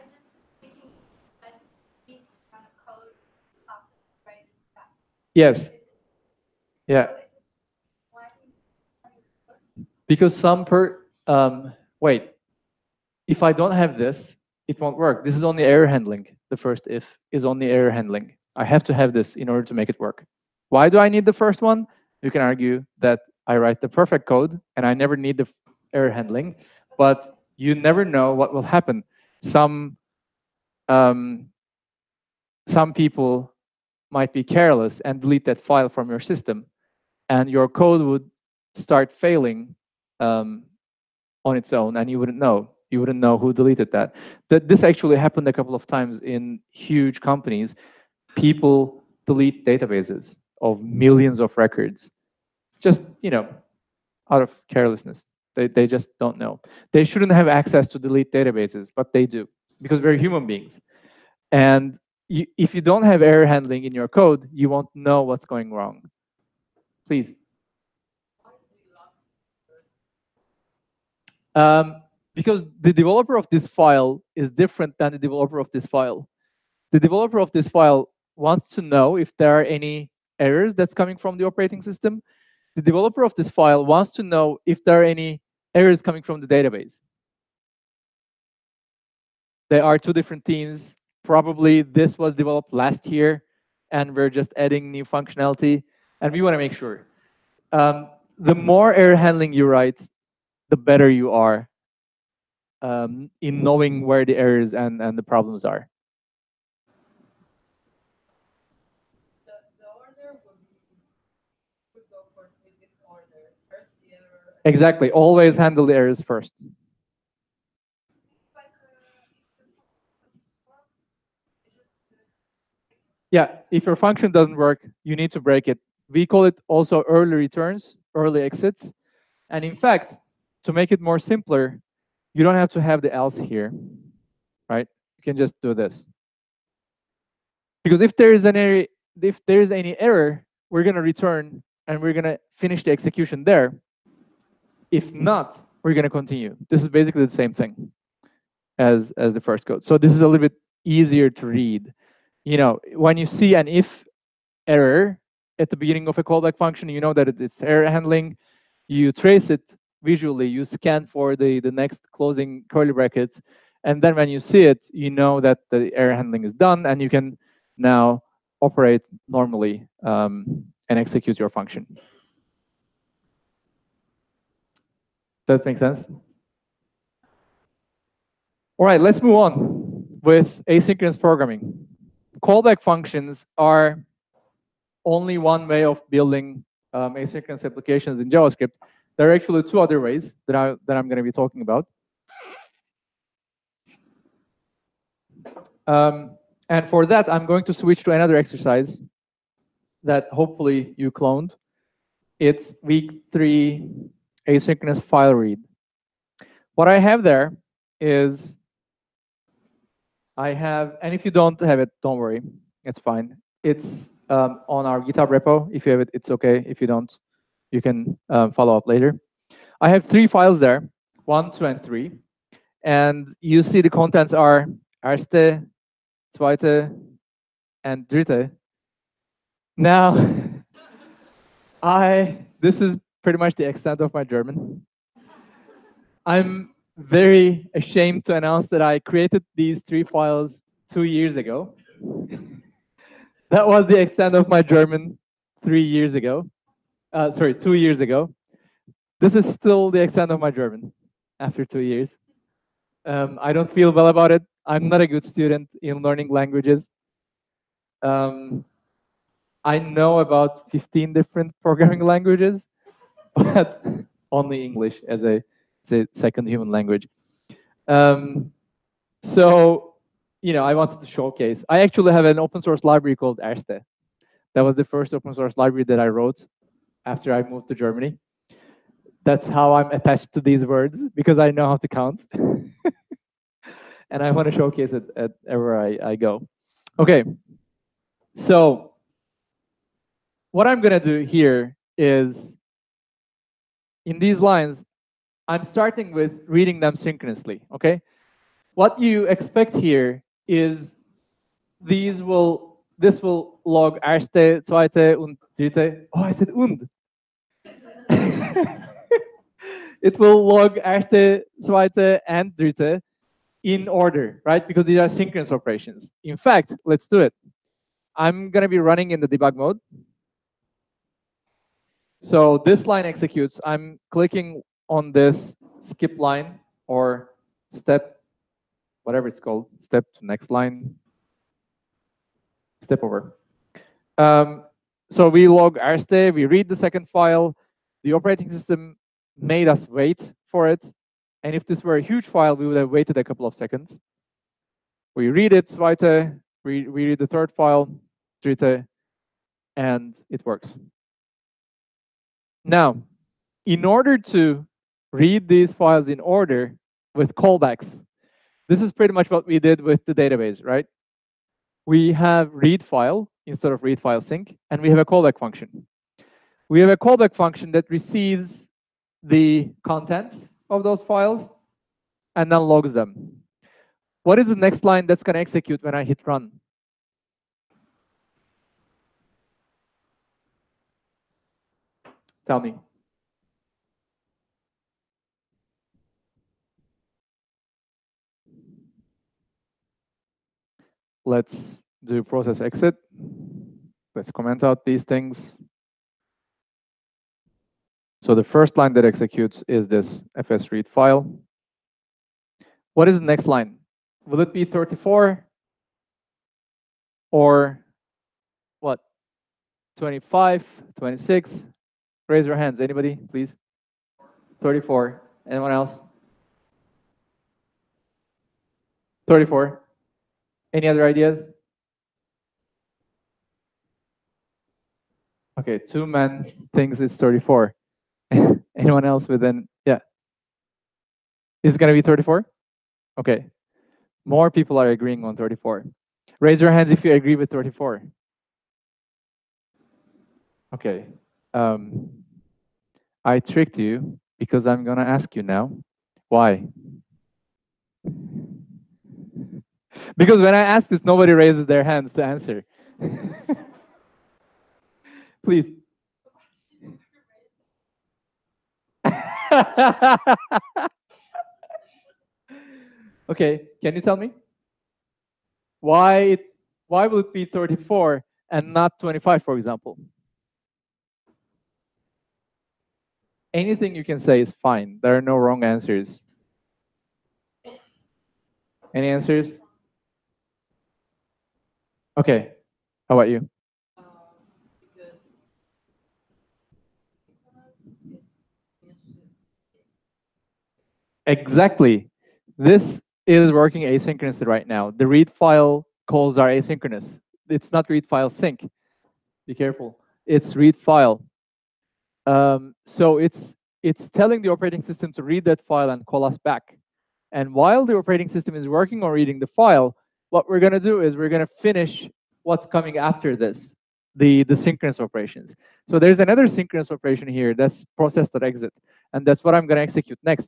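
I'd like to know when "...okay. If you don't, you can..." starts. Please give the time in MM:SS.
03:36.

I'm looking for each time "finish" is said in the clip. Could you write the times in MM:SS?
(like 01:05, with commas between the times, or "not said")
02:22, 08:31.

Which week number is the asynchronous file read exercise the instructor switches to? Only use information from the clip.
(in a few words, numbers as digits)
3.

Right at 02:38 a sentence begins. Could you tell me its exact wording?
You trace it visually, you scan for the, the next closing curly bracket.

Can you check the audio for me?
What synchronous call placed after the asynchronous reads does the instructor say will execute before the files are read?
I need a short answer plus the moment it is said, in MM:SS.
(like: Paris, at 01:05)
process.exit, at 08:37.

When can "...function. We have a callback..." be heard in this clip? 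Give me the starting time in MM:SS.
06:05.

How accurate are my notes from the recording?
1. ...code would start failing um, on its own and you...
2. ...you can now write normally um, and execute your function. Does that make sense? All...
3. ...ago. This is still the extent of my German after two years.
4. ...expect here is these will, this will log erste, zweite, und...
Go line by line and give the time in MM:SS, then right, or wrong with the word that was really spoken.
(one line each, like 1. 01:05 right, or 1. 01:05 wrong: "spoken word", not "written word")
1. 00:37 right
2. 02:46 wrong: "operate", not "write"
3. 04:07 right
4. 04:59 right.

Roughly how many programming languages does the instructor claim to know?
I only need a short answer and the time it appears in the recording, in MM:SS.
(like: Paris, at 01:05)
15, at 04:20.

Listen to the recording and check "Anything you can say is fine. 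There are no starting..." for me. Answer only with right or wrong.
wrong.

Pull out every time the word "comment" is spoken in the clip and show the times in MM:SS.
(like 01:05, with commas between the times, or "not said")
06:34.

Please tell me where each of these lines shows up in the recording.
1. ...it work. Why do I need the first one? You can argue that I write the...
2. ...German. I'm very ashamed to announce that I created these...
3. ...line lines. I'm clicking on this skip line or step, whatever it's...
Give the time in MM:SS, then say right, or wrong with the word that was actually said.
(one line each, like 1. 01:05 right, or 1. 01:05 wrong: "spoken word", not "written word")
1. 00:19 right
2. 03:54 right
3. 05:22 wrong: "executes", not "lines".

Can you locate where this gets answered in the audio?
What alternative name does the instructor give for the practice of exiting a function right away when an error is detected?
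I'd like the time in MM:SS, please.
02:07.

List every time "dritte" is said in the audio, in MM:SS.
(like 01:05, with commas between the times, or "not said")
03:48, 05:05, 05:12, 05:48.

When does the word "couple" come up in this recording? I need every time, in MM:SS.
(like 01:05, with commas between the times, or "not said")
00:45, 05:43.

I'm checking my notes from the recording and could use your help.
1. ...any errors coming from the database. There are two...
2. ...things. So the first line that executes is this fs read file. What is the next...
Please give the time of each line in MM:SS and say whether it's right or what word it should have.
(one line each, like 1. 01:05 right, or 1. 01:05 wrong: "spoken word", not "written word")
1. 01:25 right
2. 06:35 right.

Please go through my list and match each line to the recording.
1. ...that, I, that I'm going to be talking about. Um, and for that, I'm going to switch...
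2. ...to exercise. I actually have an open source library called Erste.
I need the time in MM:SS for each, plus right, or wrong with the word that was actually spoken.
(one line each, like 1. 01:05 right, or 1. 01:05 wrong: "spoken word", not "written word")
1. 03:10 right
2. 04:30 wrong: "showcase", not "exercise".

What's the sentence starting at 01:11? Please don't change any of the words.
Um, because the developer of this file is different than the developer of this file.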